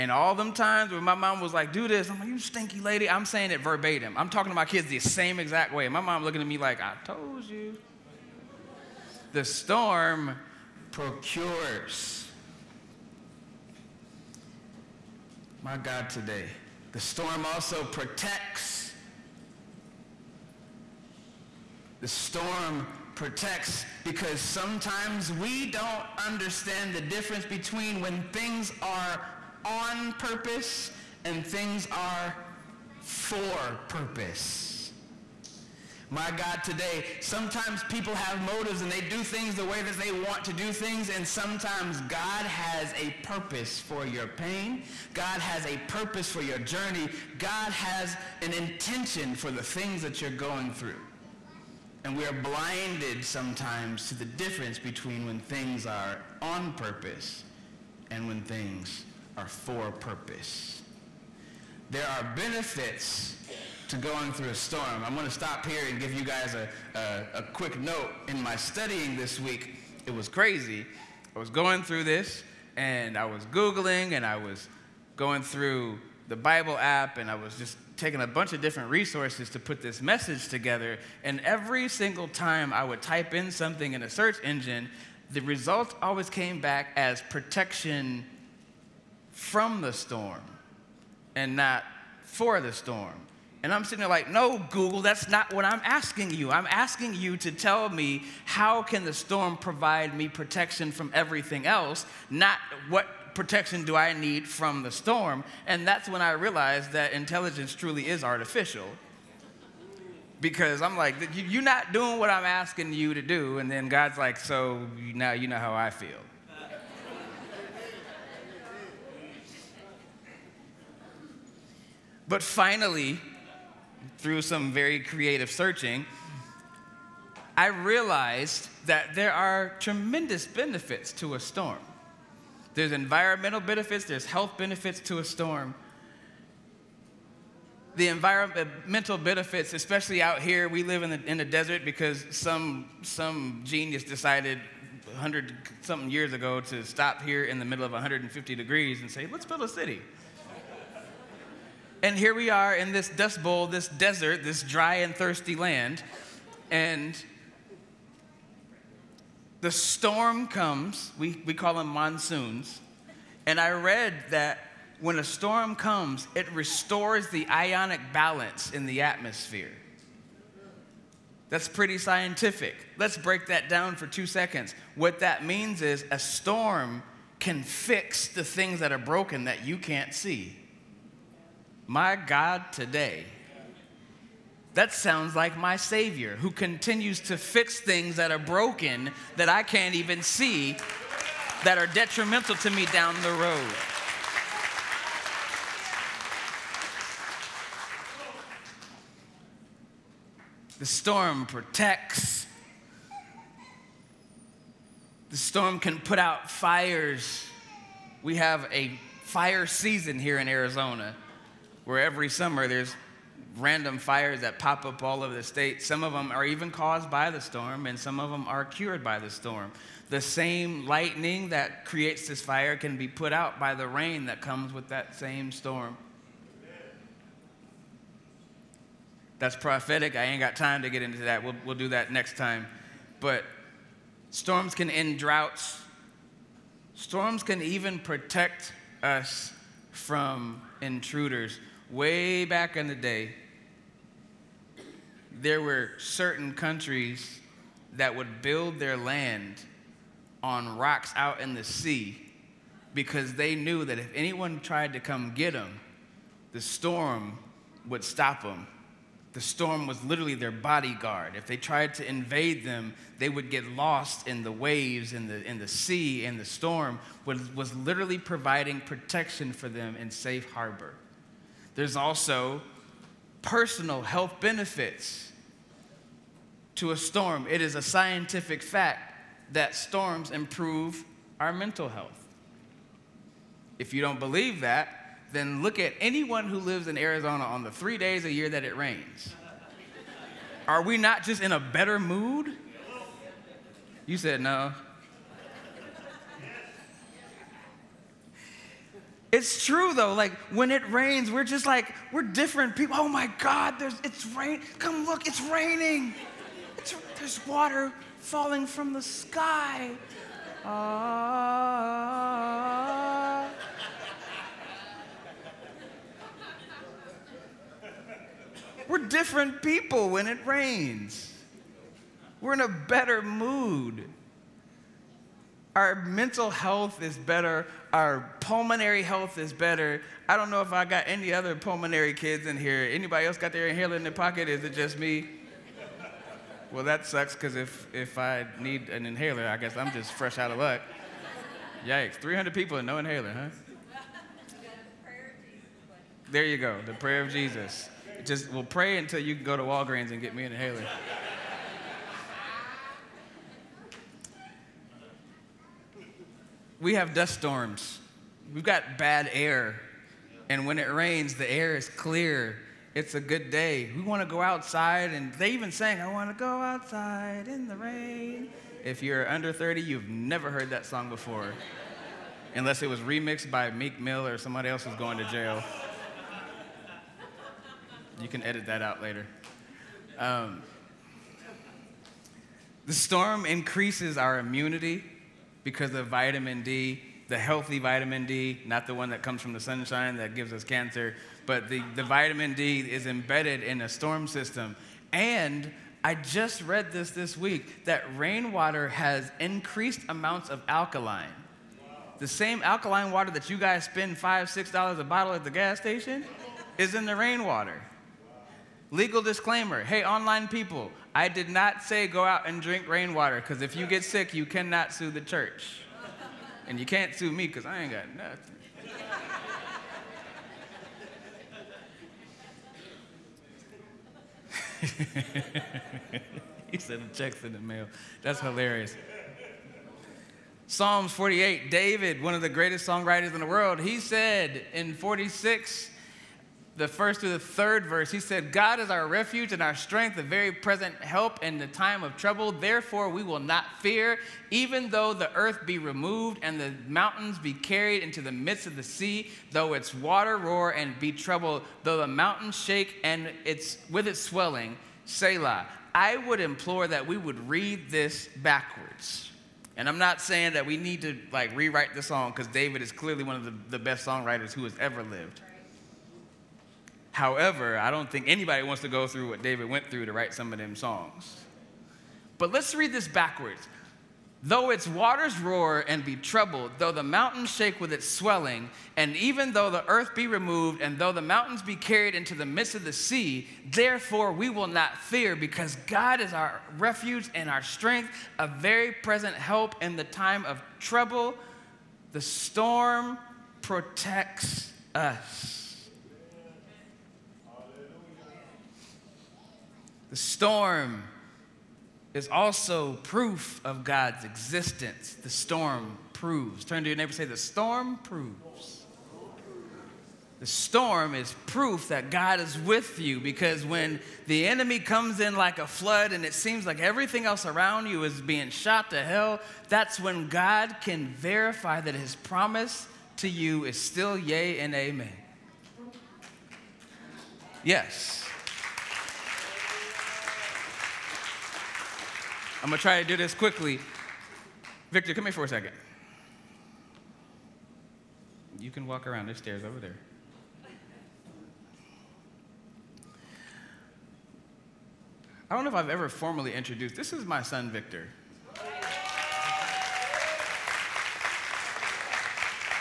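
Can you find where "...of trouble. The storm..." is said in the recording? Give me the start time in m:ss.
8:10.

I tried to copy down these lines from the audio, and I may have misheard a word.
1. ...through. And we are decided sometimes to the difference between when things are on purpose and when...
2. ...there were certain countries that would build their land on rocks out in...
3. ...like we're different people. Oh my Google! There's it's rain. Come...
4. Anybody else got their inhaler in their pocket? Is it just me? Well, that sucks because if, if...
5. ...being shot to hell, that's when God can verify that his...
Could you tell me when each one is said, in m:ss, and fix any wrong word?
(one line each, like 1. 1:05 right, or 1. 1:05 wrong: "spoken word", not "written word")
1. 0:50 wrong: "blinded", not "decided"
2. 4:05 right
3. 5:01 wrong: "God", not "Google"
4. 5:32 right
5. 8:38 right.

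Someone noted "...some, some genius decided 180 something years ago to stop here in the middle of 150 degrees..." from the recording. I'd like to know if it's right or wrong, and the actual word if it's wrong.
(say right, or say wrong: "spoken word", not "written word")
wrong: "100", not "180".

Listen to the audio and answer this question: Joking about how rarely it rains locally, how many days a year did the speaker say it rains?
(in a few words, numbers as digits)
3.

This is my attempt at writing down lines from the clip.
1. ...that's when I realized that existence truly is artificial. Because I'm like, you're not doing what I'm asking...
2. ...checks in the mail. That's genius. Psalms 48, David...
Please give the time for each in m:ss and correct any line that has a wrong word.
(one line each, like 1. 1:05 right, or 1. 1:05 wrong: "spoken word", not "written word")
1. 1:45 wrong: "intelligence", not "existence"
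2. 7:07 wrong: "hilarious", not "genius".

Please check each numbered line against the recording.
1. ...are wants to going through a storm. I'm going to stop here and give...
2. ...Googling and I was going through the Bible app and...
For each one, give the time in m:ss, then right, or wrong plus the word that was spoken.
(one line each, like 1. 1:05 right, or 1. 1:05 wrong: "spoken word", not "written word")
1. 1:02 wrong: "benefits", not "wants"
2. 1:13 right.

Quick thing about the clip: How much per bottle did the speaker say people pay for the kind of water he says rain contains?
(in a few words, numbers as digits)
5 to 6 dollars.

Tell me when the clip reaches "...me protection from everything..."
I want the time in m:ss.
1:40.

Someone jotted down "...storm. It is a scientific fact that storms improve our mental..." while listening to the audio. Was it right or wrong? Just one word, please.
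right.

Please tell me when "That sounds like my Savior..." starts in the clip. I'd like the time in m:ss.
3:04.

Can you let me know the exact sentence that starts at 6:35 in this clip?
And I just read this this week that rainwater has increased amounts of alkaline.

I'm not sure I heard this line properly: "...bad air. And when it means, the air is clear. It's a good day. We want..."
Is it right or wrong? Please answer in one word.
wrong.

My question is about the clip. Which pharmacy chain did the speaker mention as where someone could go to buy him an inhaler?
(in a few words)
Walgreens.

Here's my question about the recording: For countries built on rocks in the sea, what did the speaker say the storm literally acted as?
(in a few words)
their bodyguard.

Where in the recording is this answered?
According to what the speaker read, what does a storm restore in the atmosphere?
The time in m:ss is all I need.
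2:47.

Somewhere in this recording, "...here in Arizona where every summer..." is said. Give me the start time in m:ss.
3:30.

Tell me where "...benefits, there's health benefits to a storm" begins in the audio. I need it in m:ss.
2:13.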